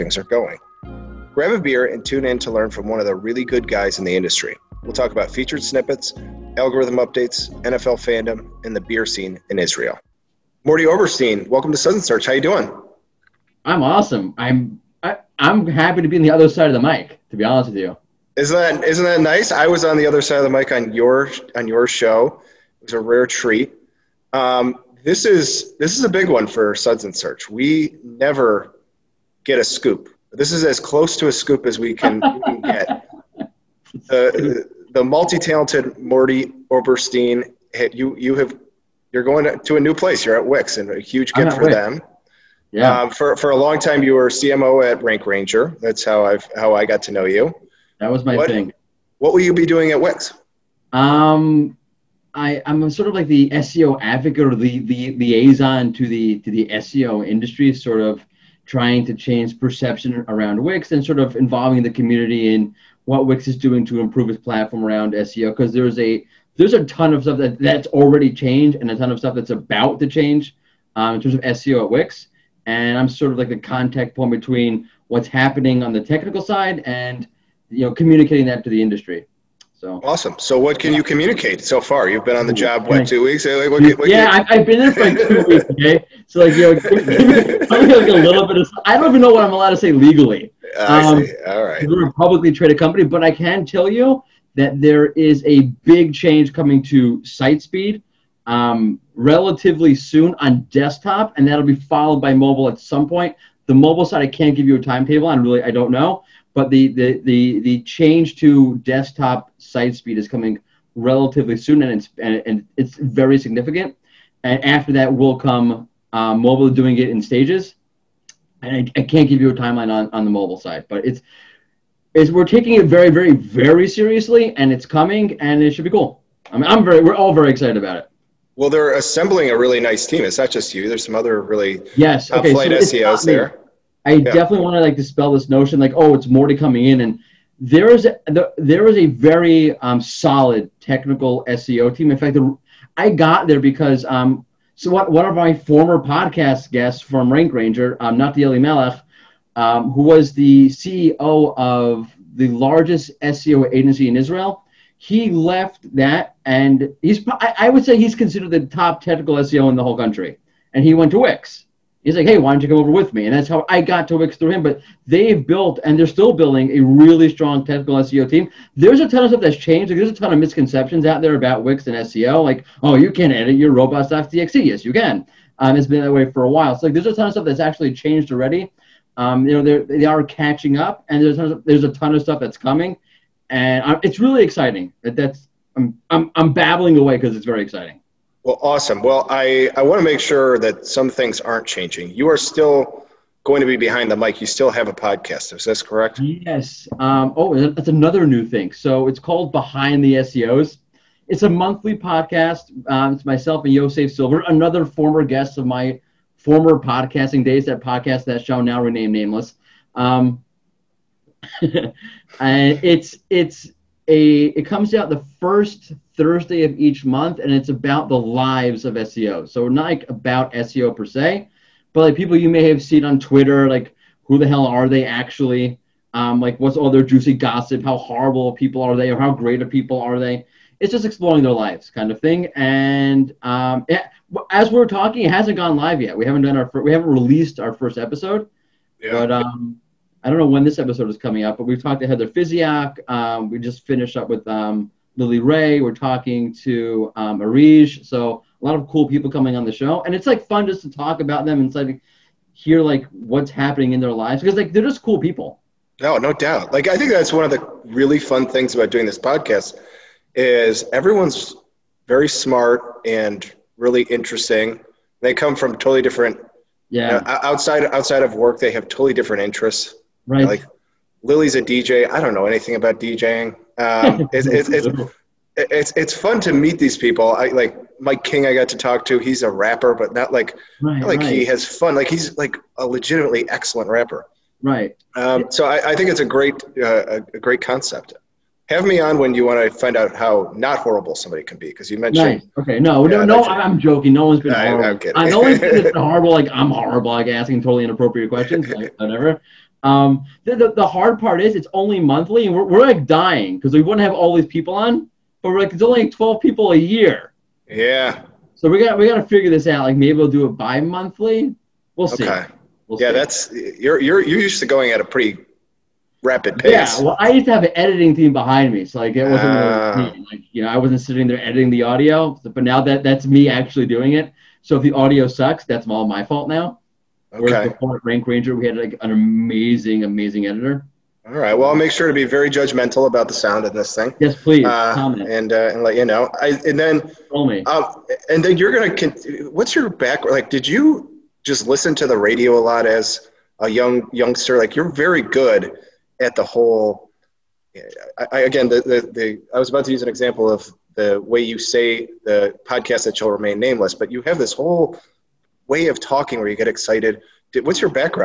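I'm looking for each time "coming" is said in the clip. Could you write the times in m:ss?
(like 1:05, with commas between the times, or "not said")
1:36, 1:50, 2:04, 2:16, 3:02, 4:01, 4:09.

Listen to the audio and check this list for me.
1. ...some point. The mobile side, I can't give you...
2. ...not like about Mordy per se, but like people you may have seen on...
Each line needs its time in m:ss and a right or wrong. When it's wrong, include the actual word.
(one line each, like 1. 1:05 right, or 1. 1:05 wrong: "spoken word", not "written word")
1. 1:42 right
2. 3:39 wrong: "SEO", not "Mordy".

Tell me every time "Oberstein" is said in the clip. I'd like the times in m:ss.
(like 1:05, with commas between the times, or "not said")
0:10, 0:36.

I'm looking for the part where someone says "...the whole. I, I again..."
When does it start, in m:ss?
5:46.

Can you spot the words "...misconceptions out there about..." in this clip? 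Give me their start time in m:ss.
2:50.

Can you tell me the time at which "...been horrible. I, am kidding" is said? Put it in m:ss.
4:54.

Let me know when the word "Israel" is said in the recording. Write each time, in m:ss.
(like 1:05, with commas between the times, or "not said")
0:09, 2:34.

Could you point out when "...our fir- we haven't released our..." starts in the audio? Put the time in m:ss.
3:56.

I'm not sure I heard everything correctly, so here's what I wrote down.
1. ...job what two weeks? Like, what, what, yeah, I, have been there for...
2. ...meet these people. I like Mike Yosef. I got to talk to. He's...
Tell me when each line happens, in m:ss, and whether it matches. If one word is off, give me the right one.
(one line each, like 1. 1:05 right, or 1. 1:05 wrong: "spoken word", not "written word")
1. 1:22 right
2. 4:36 wrong: "King", not "Yosef".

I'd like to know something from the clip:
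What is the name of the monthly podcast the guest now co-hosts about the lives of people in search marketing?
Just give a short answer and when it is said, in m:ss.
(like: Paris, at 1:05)
Behind the SEOs, at 3:19.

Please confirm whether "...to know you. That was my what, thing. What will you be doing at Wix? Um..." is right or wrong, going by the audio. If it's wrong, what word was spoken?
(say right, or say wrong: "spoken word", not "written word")
right.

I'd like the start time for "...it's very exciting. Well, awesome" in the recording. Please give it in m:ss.
3:07.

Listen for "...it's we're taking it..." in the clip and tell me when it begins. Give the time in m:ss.
2:02.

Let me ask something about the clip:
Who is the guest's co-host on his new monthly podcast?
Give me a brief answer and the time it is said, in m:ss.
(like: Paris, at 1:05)
Yosef Silver, at 3:23.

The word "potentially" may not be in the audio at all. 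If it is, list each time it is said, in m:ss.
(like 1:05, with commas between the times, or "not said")
not said.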